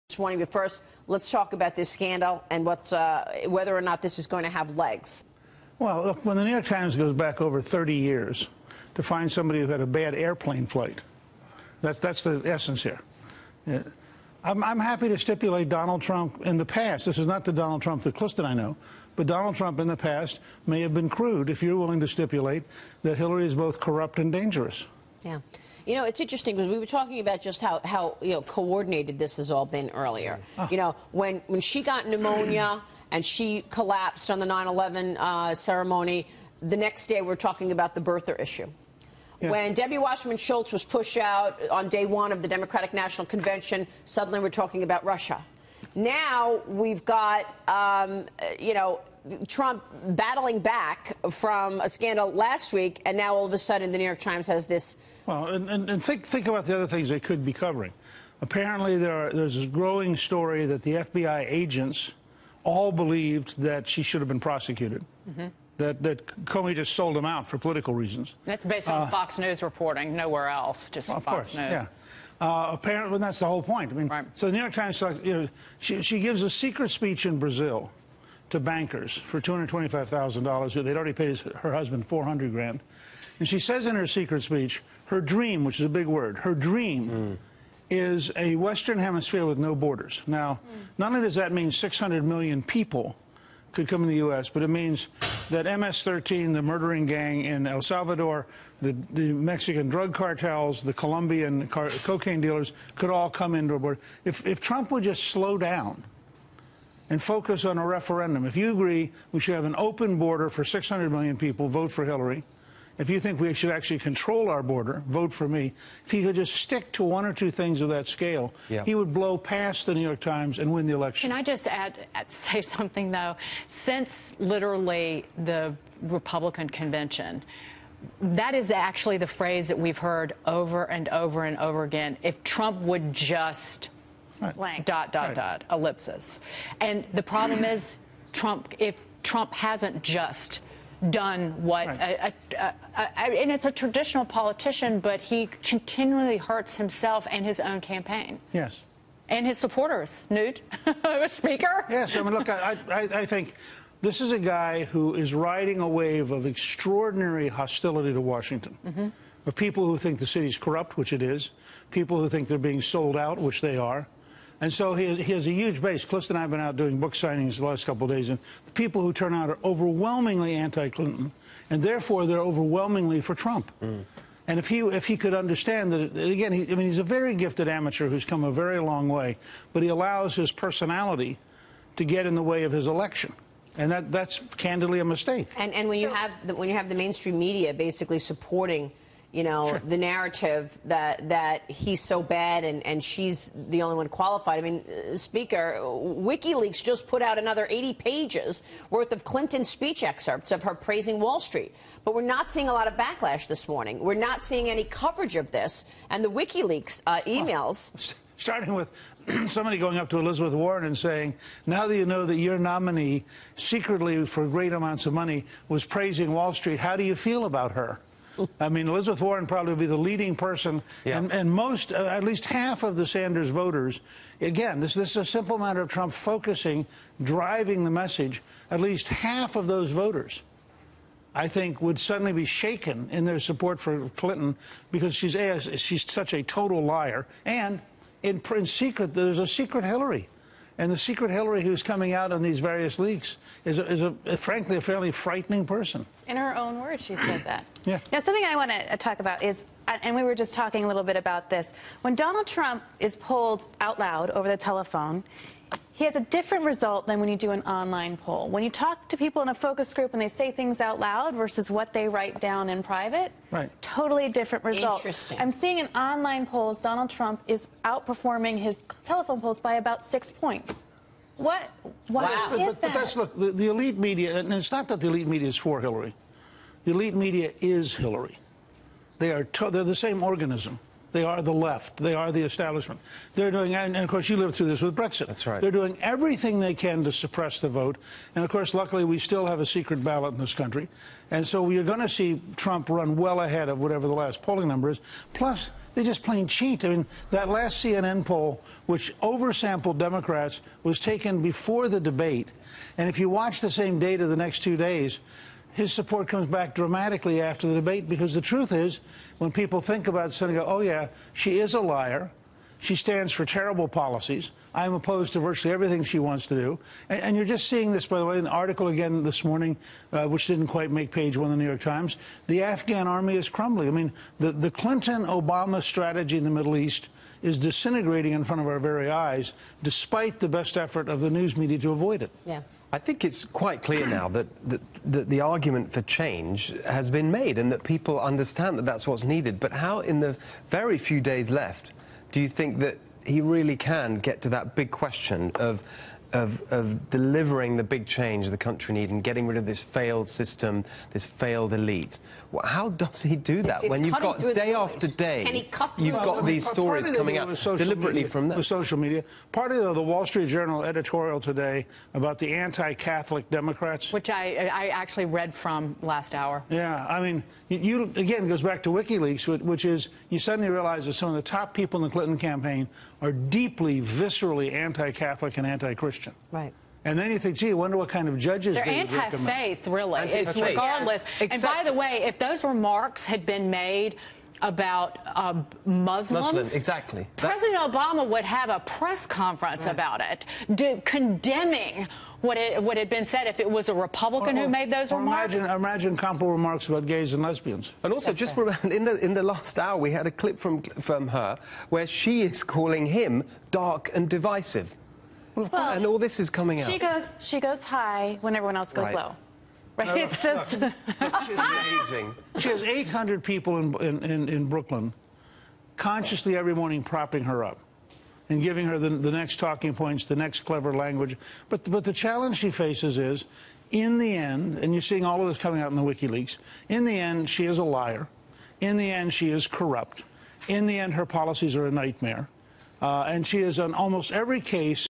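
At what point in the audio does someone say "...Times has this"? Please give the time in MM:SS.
00:54.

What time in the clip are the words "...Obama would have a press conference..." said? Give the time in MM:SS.
06:27.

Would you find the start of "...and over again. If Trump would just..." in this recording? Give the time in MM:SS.
02:11.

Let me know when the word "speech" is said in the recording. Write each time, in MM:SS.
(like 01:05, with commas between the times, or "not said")
01:16, 01:24, 03:19.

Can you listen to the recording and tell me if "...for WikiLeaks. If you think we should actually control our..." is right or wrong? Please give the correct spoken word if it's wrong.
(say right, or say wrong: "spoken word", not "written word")
wrong: "Hillary", not "WikiLeaks".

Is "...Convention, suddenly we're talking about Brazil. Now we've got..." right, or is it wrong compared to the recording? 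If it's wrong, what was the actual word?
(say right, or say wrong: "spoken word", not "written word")
wrong: "Russia", not "Brazil".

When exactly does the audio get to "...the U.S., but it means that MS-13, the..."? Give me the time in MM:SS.
01:34.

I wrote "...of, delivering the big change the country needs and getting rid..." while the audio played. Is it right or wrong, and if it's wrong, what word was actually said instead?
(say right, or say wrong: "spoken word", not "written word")
right.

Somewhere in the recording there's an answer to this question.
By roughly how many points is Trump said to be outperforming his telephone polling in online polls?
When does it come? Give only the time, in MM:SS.
04:30.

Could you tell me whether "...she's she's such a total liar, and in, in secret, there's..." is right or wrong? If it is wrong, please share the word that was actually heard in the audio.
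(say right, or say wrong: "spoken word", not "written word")
right.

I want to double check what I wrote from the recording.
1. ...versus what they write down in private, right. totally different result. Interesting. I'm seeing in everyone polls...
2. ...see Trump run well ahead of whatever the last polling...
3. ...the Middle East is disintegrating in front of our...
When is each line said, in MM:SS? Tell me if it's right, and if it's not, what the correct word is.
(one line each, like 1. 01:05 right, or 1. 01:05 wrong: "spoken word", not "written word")
1. 04:21 wrong: "online", not "everyone"
2. 04:52 right
3. 05:26 right.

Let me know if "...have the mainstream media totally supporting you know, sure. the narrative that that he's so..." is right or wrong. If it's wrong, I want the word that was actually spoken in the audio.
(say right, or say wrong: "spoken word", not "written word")
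wrong: "basically", not "totally".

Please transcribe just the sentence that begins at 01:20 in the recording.
They'd already paid her husband 400 grand.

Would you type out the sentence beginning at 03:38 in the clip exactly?
I mean, Elizabeth Warren probably be the leading person, yeah.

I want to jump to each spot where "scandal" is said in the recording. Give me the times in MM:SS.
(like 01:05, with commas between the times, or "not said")
00:01, 00:51.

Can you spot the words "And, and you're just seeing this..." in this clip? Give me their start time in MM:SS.
05:17.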